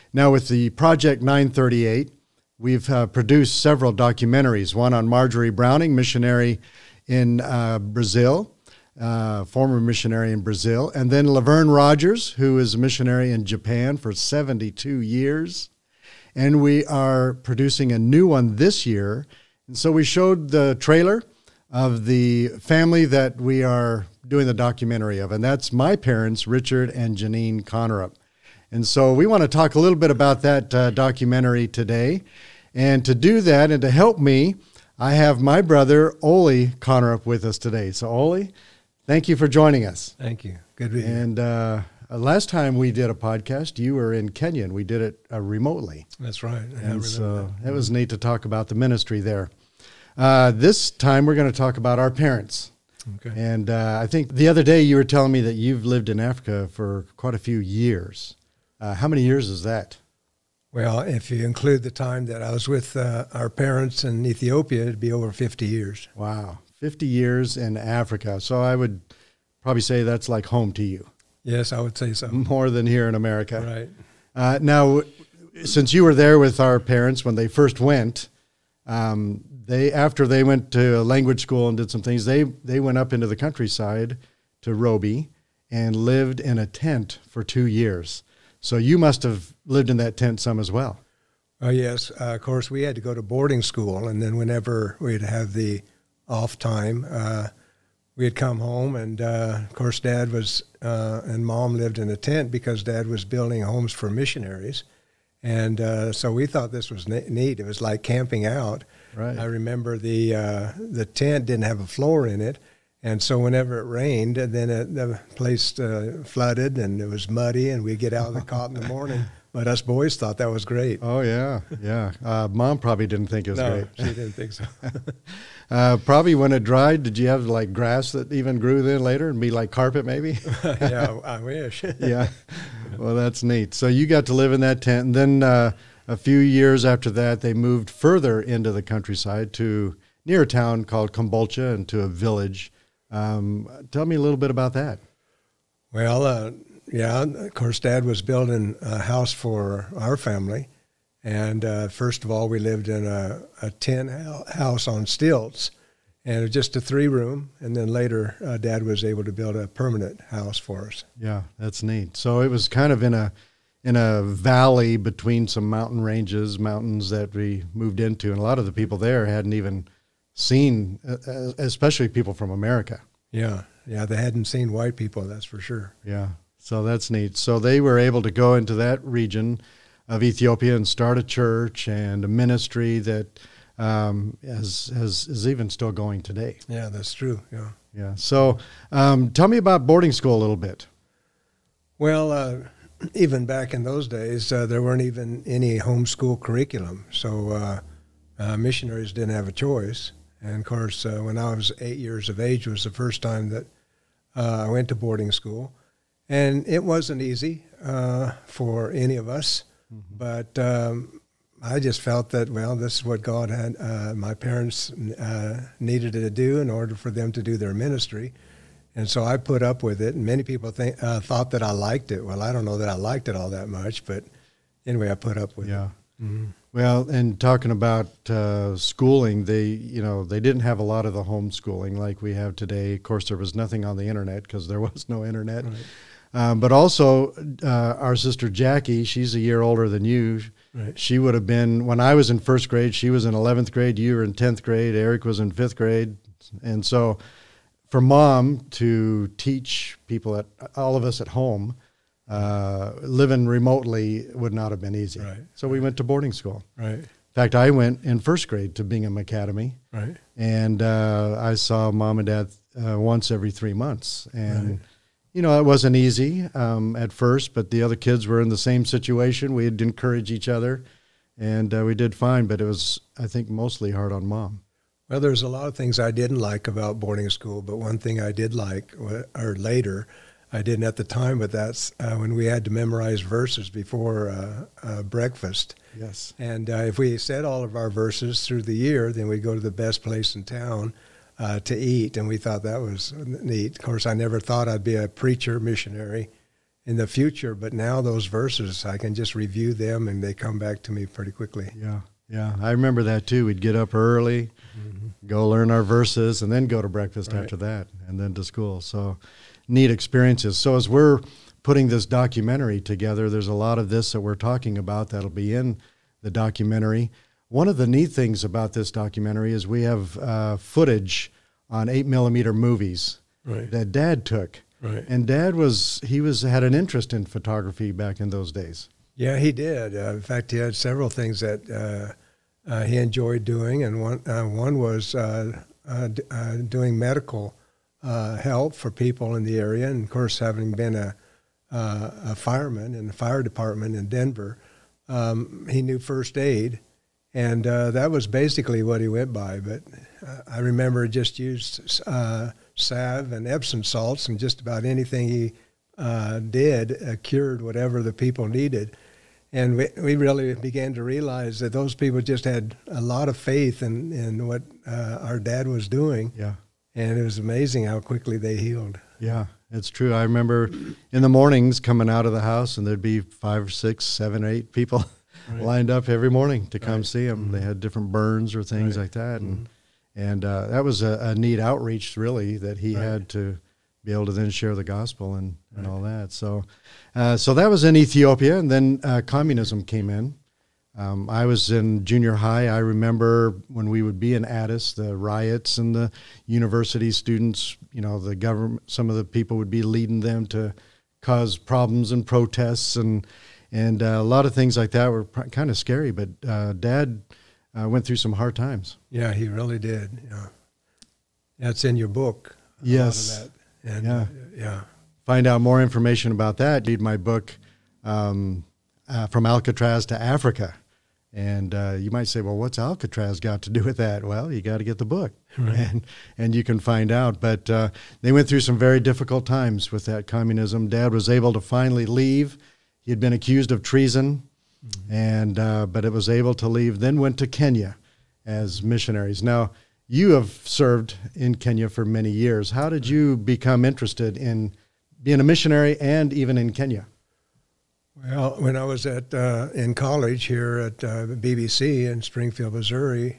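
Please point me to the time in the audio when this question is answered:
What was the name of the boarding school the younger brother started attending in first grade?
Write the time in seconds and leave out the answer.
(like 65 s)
258 s.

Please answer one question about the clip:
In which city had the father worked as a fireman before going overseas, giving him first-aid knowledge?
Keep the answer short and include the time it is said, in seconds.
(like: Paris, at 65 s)
Denver, at 344 s.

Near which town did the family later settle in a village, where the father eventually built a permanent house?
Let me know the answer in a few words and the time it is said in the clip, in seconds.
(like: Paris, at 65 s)
Kombolcha, at 141 s.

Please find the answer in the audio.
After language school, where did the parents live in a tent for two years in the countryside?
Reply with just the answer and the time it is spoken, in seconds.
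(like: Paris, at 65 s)
Roby, at 84 s.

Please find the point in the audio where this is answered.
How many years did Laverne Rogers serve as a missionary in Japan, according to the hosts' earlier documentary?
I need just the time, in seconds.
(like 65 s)
14 s.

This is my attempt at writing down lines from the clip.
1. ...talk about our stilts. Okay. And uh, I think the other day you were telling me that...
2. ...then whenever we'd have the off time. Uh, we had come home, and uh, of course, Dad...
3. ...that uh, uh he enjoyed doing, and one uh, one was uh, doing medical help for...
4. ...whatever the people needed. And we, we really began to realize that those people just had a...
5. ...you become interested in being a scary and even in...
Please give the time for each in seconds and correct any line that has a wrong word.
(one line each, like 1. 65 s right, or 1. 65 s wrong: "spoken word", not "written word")
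1. 51 s wrong: "parents", not "stilts"
2. 94 s right
3. 331 s right
4. 357 s right
5. 443 s wrong: "missionary", not "scary".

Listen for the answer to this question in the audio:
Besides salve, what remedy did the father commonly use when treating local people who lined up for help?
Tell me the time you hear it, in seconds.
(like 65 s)
353 s.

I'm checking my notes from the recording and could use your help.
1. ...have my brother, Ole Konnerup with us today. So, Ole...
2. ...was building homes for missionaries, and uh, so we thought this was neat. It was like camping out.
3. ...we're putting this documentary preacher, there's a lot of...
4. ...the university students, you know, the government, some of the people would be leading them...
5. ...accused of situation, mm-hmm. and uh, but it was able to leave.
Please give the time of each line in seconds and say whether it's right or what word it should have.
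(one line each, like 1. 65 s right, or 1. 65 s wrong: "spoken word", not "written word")
1. 35 s right
2. 103 s right
3. 310 s wrong: "together", not "preacher"
4. 395 s right
5. 433 s wrong: "treason", not "situation".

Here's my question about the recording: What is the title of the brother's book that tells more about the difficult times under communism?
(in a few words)
From Alcatraz to Africa.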